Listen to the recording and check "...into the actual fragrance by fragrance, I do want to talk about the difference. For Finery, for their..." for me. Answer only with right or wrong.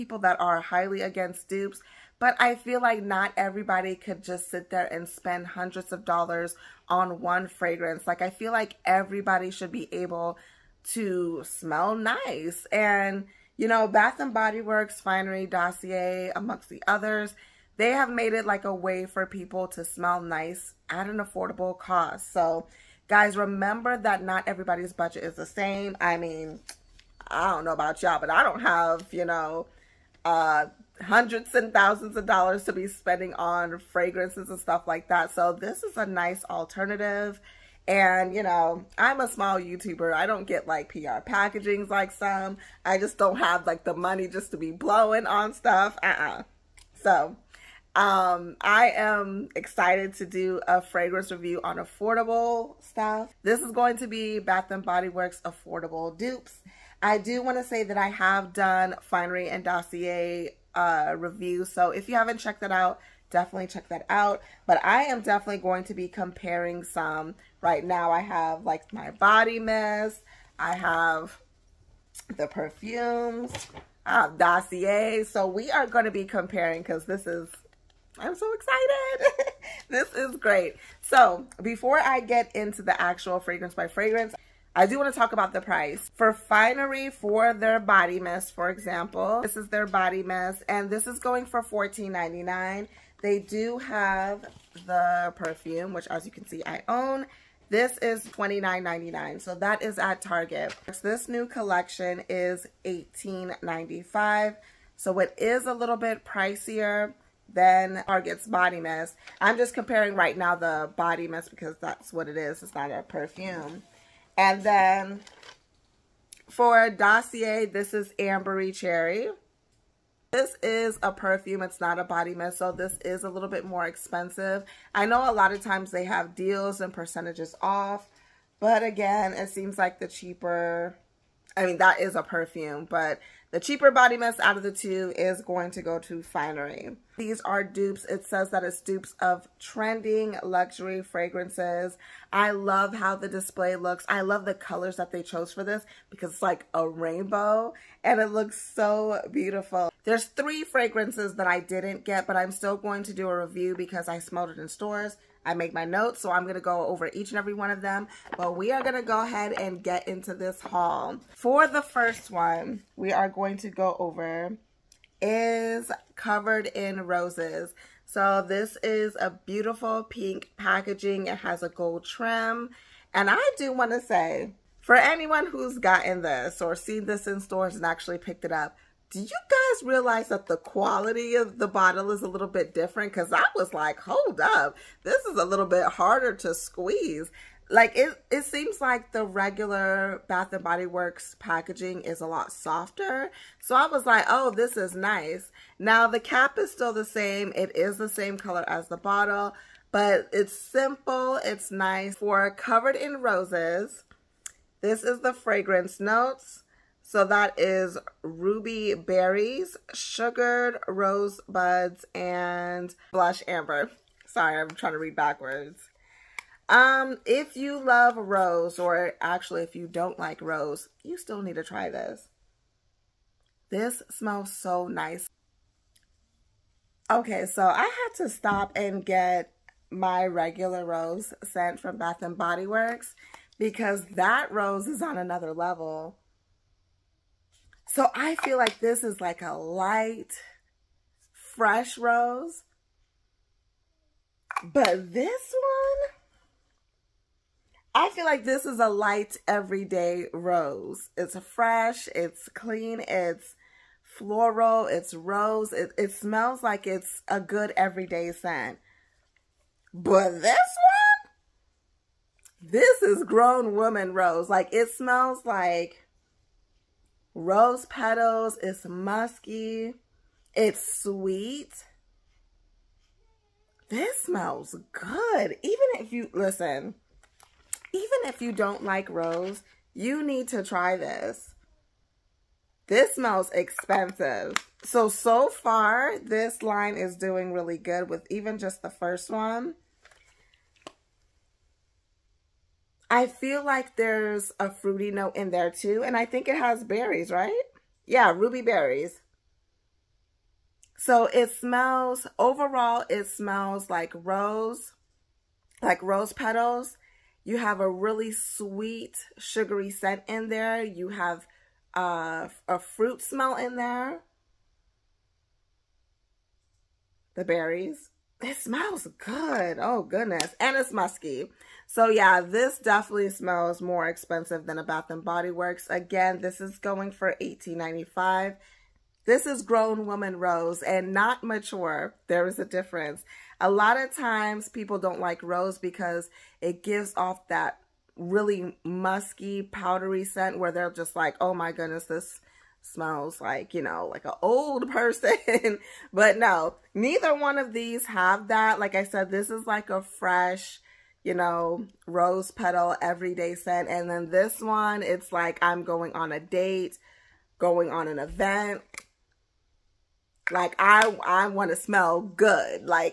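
wrong.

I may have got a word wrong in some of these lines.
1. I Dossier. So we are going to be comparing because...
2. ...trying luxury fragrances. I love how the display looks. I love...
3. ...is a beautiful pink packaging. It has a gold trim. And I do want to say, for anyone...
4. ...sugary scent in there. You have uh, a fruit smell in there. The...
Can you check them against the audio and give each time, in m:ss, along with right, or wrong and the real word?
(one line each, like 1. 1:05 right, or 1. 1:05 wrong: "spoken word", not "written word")
1. 1:14 right
2. 2:19 wrong: "trending", not "trying"
3. 2:48 right
4. 5:09 right.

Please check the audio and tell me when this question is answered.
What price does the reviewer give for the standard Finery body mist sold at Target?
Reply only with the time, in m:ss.
1:31.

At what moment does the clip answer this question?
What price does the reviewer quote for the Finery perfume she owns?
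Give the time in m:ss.
1:38.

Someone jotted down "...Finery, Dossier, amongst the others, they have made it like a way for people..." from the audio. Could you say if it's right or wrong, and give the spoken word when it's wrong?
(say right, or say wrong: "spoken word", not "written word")
right.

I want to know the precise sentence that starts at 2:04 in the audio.
I know a lot of times they have deals and percentages off, but again, it seems like the cheaper...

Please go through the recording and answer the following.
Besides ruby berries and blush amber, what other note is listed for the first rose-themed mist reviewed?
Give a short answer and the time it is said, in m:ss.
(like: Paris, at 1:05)
sugared rosebuds, at 3:29.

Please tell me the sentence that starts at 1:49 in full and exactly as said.
I'm just comparing right now the Body Mist because that's what it is.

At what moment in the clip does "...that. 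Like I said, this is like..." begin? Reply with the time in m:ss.
5:48.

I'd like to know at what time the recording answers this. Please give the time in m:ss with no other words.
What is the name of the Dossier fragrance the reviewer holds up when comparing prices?
1:58.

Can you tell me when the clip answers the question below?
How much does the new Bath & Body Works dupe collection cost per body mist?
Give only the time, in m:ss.
1:41.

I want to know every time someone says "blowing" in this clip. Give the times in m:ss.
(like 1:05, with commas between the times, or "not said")
0:44.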